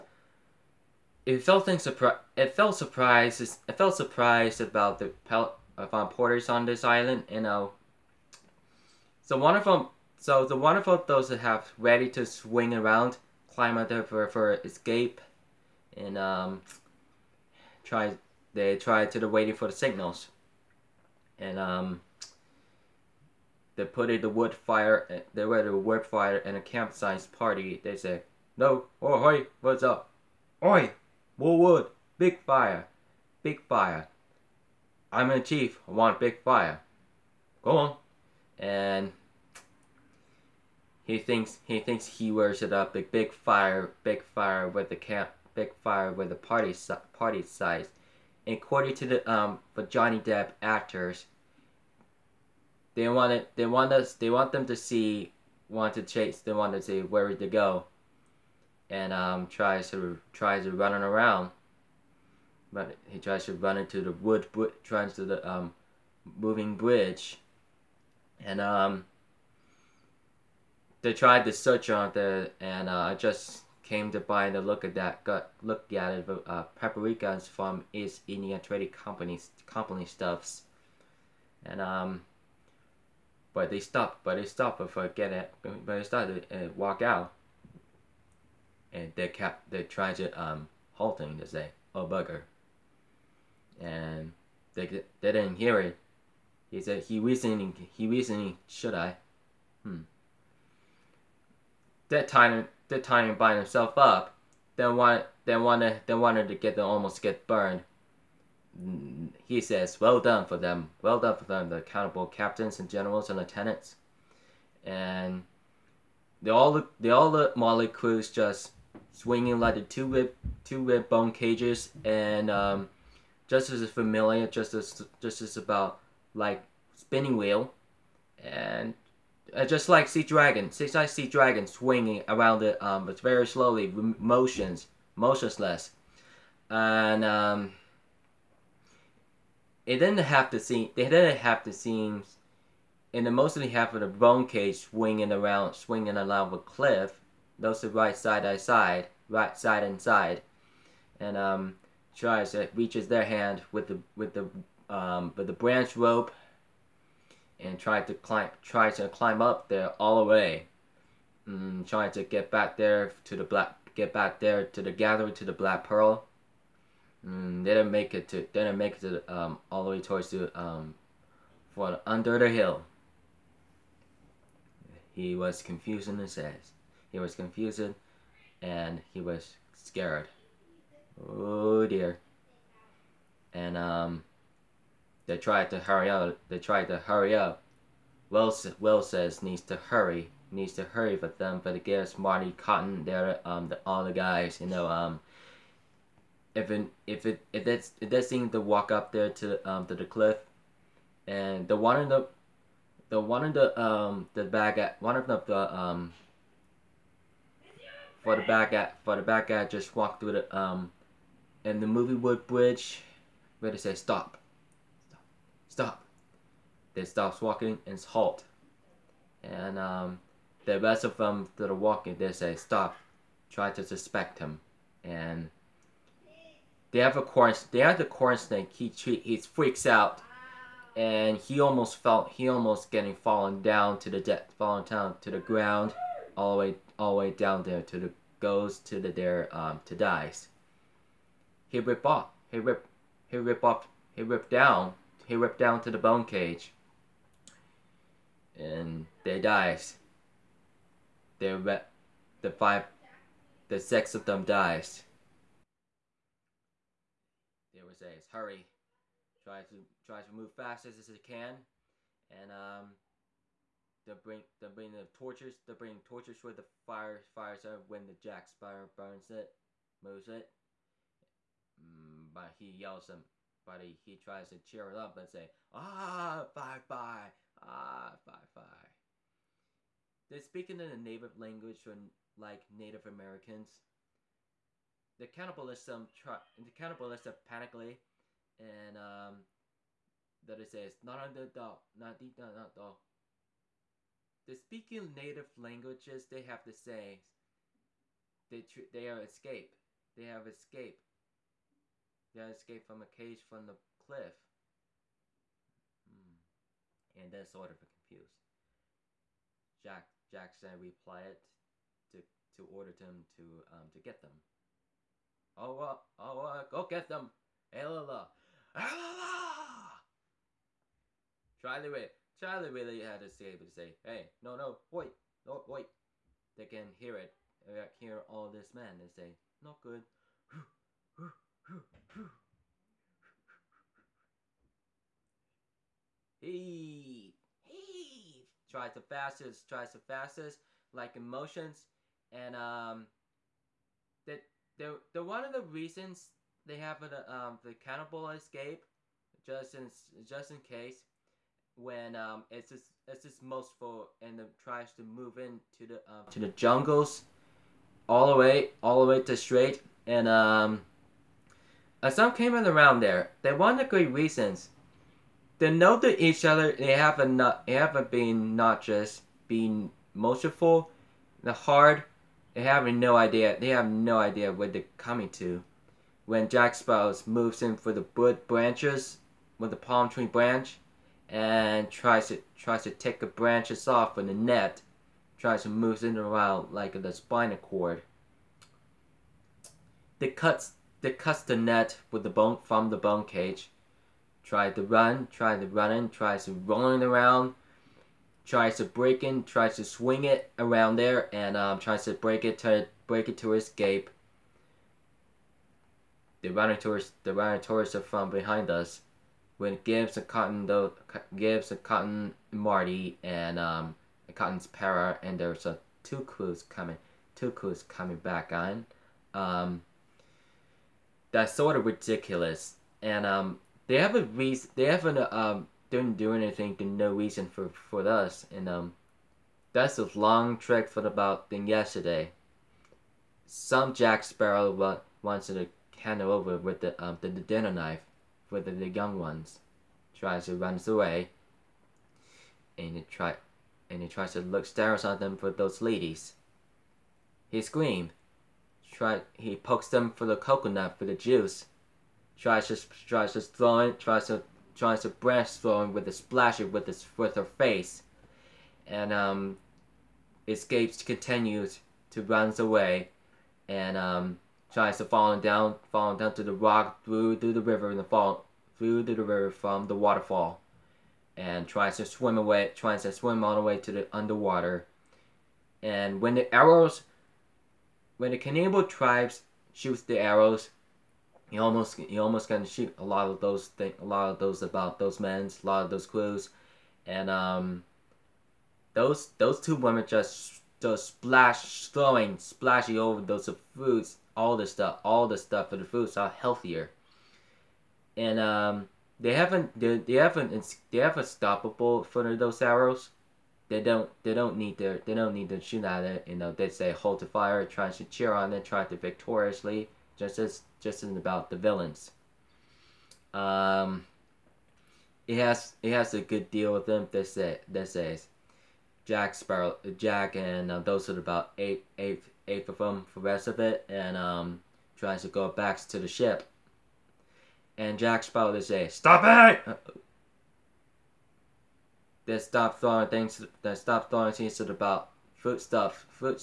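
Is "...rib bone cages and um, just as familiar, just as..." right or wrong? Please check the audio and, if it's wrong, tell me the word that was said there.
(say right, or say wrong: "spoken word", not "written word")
right.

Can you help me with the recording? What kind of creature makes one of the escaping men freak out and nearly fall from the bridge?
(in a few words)
corn snake.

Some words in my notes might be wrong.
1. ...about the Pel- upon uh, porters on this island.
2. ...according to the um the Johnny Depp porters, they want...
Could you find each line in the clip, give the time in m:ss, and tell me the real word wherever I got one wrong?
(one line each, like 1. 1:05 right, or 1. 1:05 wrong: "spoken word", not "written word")
1. 0:04 right
2. 0:48 wrong: "actors", not "porters".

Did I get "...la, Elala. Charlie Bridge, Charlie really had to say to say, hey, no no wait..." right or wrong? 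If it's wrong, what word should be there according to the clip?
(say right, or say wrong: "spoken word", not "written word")
wrong: "Ray", not "Bridge".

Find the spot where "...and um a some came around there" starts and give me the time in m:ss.
6:00.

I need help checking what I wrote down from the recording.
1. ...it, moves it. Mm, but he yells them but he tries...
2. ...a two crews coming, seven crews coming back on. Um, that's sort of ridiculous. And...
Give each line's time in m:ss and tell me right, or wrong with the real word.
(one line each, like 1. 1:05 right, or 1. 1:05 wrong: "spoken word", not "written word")
1. 4:29 right
2. 6:55 wrong: "two", not "seven".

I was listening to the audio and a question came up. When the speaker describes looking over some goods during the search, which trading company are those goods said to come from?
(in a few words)
East Indian Trading Company.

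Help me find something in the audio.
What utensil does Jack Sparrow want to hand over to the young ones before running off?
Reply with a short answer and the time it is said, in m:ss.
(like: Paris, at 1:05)
dinner knife, at 7:17.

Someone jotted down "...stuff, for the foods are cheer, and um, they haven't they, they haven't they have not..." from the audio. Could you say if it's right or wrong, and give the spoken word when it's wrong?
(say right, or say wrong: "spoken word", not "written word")
wrong: "healthier", not "cheer".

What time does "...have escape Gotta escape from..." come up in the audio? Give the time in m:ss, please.
5:00.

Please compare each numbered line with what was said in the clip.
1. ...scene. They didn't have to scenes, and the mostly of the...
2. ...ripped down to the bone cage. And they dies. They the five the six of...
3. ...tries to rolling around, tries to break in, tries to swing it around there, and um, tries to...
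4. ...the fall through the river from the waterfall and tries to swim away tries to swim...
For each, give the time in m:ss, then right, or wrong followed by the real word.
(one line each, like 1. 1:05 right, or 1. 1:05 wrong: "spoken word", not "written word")
1. 2:20 right
2. 4:05 right
3. 6:36 right
4. 7:47 right.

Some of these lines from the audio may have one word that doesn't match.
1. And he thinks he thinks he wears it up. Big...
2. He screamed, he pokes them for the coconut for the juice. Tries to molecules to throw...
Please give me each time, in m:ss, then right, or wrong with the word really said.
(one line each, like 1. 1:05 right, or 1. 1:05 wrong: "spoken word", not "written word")
1. 0:38 right
2. 7:27 wrong: "tries", not "molecules".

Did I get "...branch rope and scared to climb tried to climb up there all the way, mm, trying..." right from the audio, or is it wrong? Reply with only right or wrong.
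wrong.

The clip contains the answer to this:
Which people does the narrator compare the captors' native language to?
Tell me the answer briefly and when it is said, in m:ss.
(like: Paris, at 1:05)
Native Americans, at 4:42.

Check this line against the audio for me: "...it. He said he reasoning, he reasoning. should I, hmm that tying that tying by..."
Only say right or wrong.
right.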